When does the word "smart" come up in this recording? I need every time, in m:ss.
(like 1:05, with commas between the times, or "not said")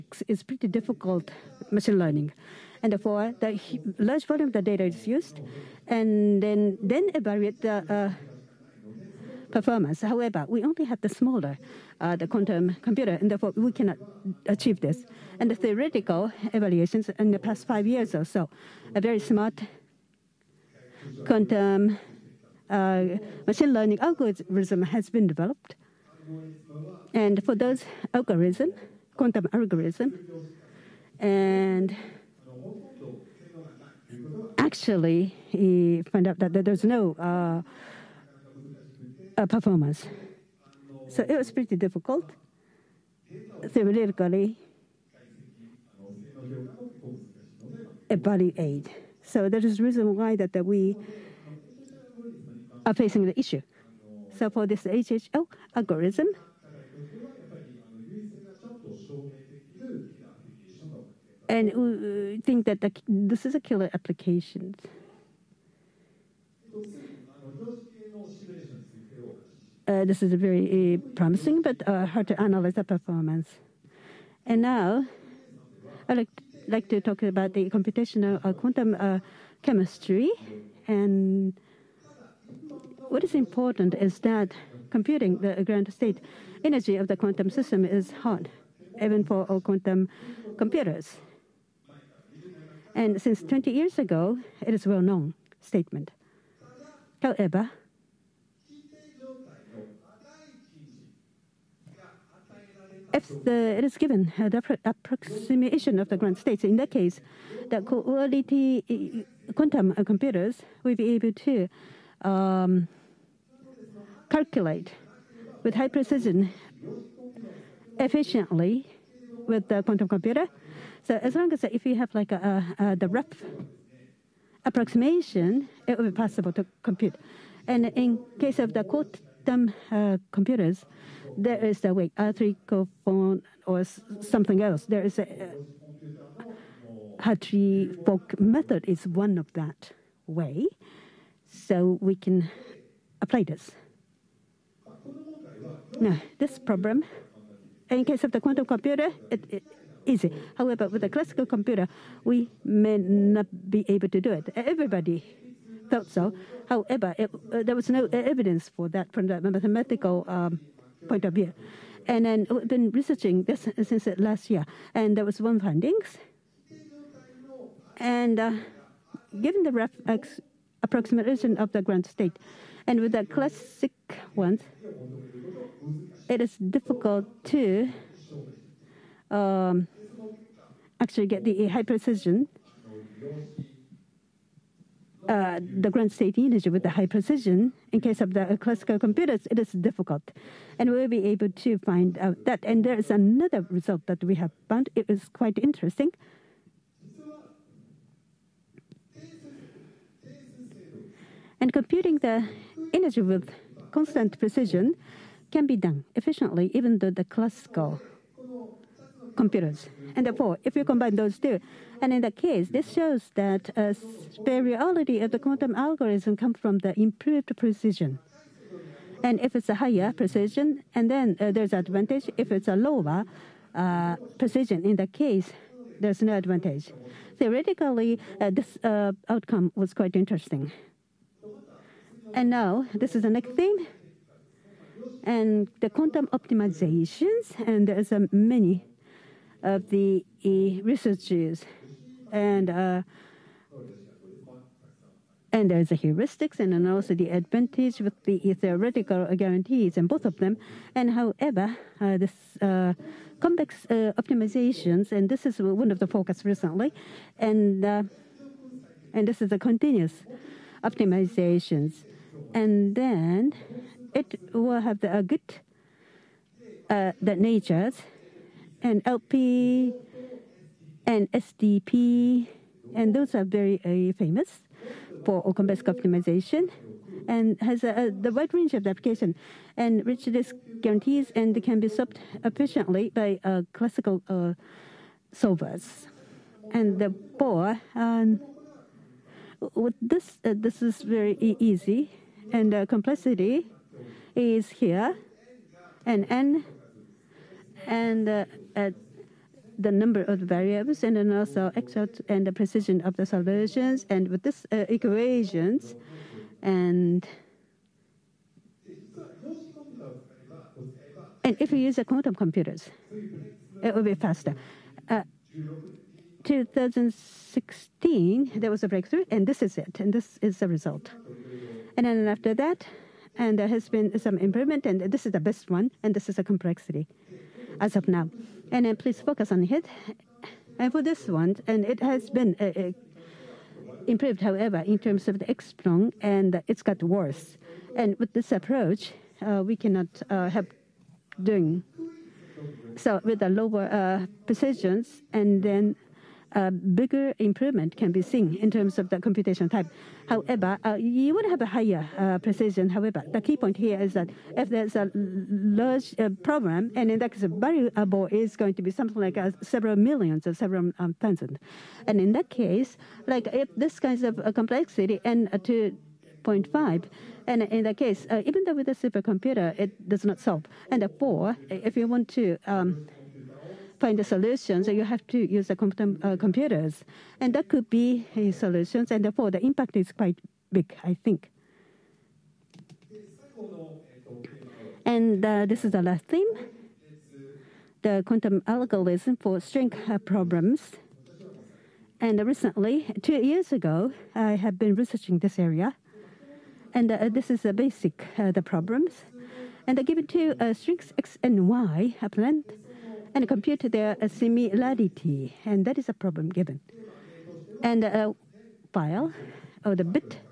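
0:19.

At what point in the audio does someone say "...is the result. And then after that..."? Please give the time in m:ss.
5:20.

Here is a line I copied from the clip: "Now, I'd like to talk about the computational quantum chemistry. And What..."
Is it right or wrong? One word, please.
right.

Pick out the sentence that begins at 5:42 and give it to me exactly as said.
So With the lower precisions and then a bigger improvement can be seen in terms of the computation time.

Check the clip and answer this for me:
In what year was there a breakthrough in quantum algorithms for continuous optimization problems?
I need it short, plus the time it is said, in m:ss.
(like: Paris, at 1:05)
2016, at 5:16.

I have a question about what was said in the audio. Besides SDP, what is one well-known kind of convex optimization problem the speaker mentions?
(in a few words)
LP.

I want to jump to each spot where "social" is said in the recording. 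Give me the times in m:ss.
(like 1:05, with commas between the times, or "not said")
not said.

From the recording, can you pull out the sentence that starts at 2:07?
And in case of the quantum uh, computers, there is way, wait, phone or something else.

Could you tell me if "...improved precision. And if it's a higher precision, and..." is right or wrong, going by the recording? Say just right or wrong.
right.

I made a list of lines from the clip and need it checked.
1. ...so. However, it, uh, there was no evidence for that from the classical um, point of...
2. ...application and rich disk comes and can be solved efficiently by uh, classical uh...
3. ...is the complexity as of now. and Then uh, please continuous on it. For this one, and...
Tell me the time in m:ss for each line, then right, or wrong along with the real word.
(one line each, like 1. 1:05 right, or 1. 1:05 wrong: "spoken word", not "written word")
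1. 2:36 wrong: "mathematical", not "classical"
2. 4:38 wrong: "guarantees", not "comes"
3. 5:26 wrong: "focus", not "continuous".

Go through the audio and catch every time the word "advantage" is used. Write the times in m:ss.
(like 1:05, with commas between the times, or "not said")
3:41, 3:46, 4:07.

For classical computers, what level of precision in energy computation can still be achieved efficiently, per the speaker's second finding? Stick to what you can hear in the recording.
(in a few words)
constant precision.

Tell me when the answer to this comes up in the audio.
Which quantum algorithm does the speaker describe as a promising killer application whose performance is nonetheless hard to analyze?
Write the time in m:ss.
0:54.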